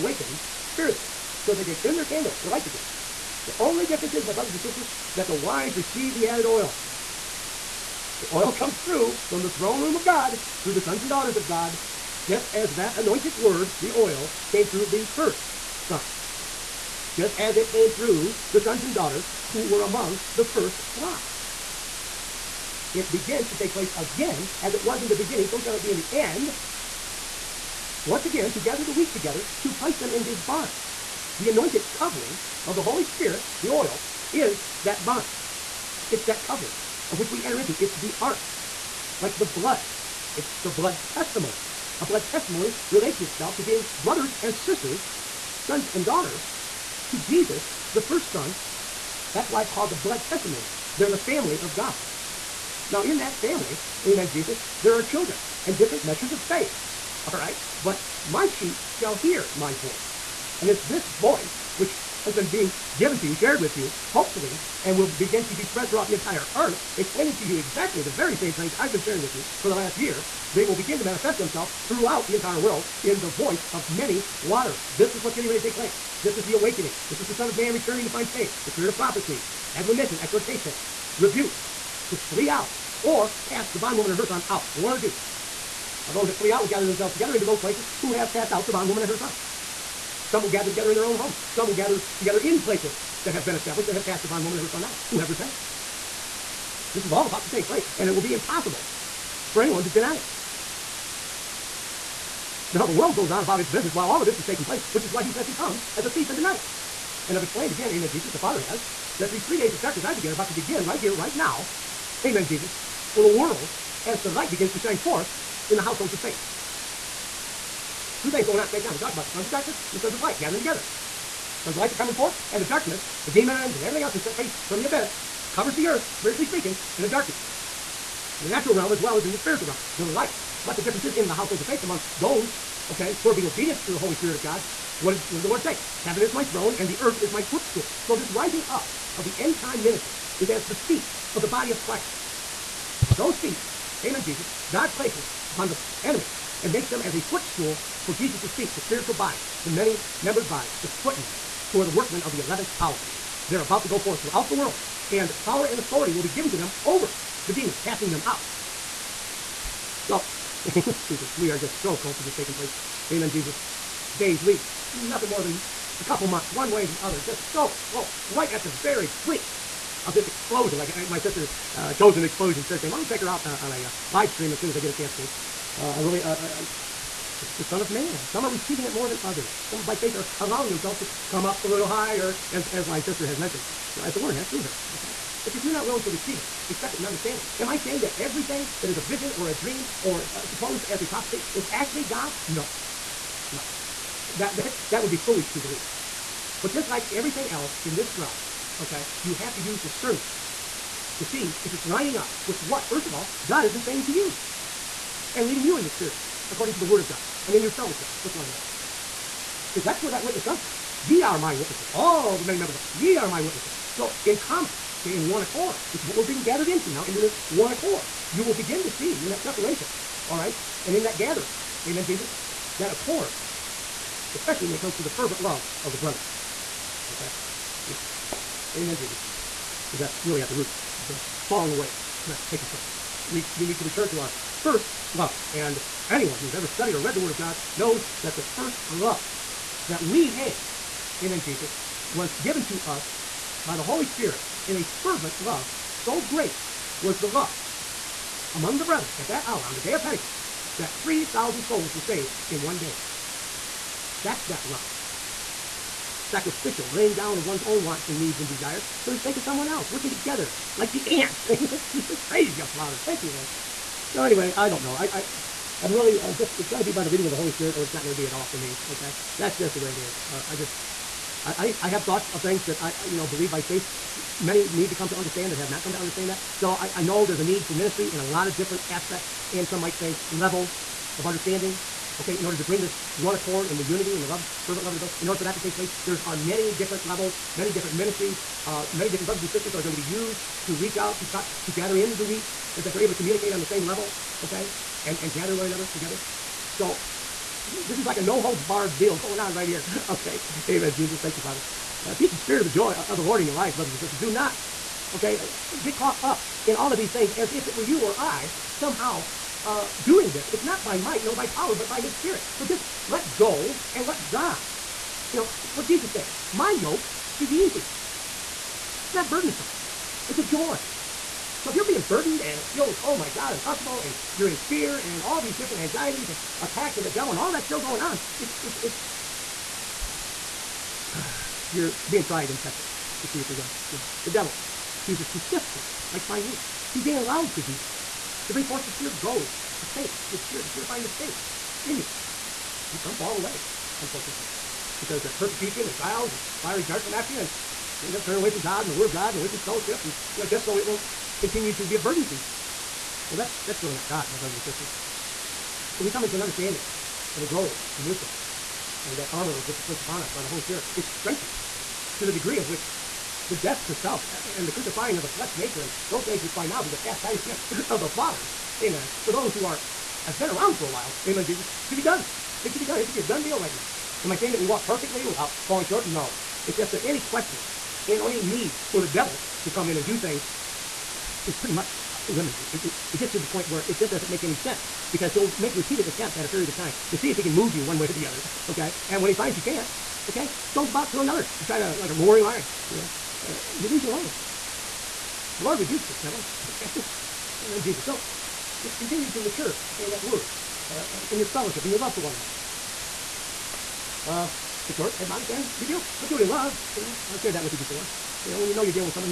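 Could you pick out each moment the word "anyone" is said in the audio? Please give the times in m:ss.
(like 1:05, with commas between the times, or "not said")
1:39, 3:56.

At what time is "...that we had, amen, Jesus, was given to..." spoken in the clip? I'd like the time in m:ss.
3:59.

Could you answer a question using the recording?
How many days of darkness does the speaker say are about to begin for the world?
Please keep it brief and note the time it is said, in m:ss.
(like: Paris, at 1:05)
3, at 1:49.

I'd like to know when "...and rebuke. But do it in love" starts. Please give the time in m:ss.
6:45.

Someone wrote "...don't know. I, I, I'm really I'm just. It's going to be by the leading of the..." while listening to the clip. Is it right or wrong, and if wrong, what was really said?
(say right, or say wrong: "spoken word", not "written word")
right.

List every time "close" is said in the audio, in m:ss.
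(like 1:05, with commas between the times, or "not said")
2:42, 2:47.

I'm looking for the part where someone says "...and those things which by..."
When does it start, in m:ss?
6:05.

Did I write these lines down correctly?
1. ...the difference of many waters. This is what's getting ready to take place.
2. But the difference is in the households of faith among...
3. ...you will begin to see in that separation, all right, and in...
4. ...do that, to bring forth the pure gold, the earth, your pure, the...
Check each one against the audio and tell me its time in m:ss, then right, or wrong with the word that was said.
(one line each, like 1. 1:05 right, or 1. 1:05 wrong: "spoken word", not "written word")
1. 1:13 wrong: "voice", not "difference"
2. 2:10 right
3. 3:38 right
4. 5:37 wrong: "faith", not "earth".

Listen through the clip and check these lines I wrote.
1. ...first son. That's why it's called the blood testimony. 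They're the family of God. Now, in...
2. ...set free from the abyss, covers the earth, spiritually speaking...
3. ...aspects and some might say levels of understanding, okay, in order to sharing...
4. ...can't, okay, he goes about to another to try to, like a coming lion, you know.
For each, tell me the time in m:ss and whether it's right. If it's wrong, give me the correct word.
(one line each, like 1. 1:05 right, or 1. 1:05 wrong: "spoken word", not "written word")
1. 0:48 right
2. 2:04 right
3. 4:38 wrong: "bring", not "sharing"
4. 6:29 wrong: "roaring", not "coming".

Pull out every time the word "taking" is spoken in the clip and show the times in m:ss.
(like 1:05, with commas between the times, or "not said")
1:44, 2:42, 3:52.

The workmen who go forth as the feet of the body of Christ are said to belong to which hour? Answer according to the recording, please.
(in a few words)
11th hour.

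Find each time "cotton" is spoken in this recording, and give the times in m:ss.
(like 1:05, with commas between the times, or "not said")
not said.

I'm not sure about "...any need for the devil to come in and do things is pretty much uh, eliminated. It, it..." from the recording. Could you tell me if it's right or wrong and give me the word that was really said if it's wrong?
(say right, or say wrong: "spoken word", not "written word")
right.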